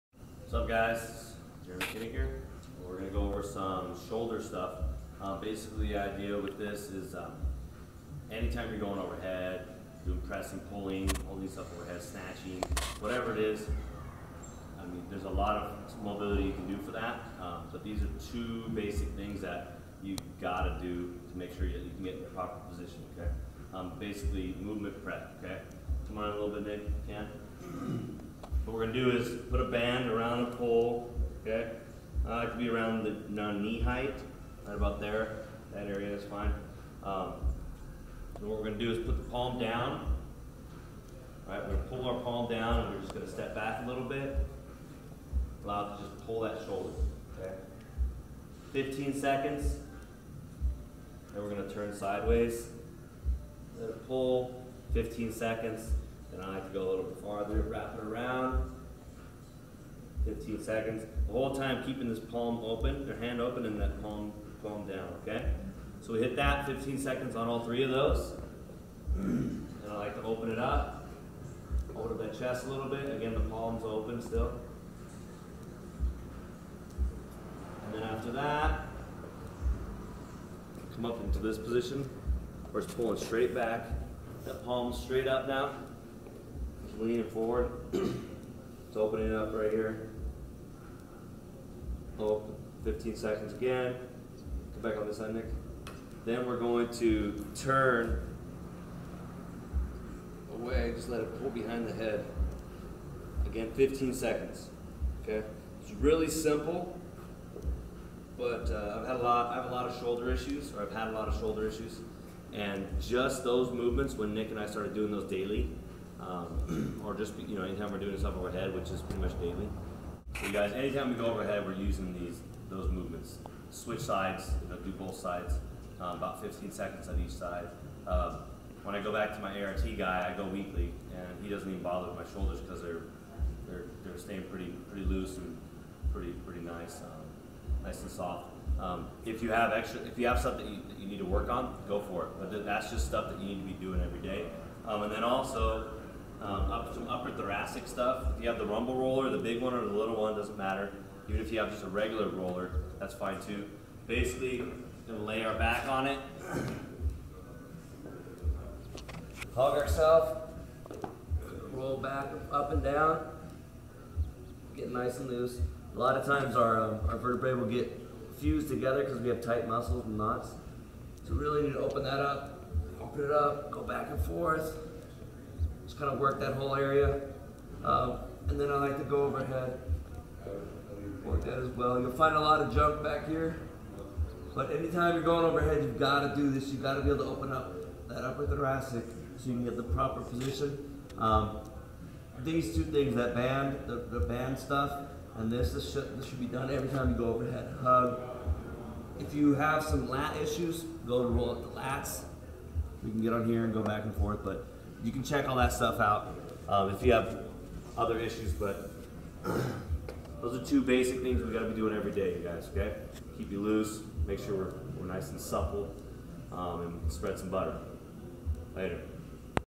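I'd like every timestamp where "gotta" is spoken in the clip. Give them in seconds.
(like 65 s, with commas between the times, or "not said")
20 s, 211 s.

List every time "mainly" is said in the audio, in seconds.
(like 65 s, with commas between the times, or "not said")
not said.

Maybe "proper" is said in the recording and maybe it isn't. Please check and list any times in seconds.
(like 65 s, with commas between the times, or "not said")
22 s, 189 s.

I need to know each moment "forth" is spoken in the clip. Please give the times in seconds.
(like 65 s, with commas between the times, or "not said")
174 s, 204 s.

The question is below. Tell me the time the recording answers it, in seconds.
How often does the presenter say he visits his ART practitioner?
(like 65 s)
130 s.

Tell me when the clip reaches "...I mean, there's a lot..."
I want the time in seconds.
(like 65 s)
14 s.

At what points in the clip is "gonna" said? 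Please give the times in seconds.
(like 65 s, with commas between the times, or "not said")
2 s, 155 s.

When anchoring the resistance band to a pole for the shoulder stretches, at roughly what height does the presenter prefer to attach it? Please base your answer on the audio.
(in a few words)
Knee height.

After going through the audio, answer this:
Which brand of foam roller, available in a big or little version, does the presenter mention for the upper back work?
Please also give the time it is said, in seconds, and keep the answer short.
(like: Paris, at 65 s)
Rumble roller, at 148 s.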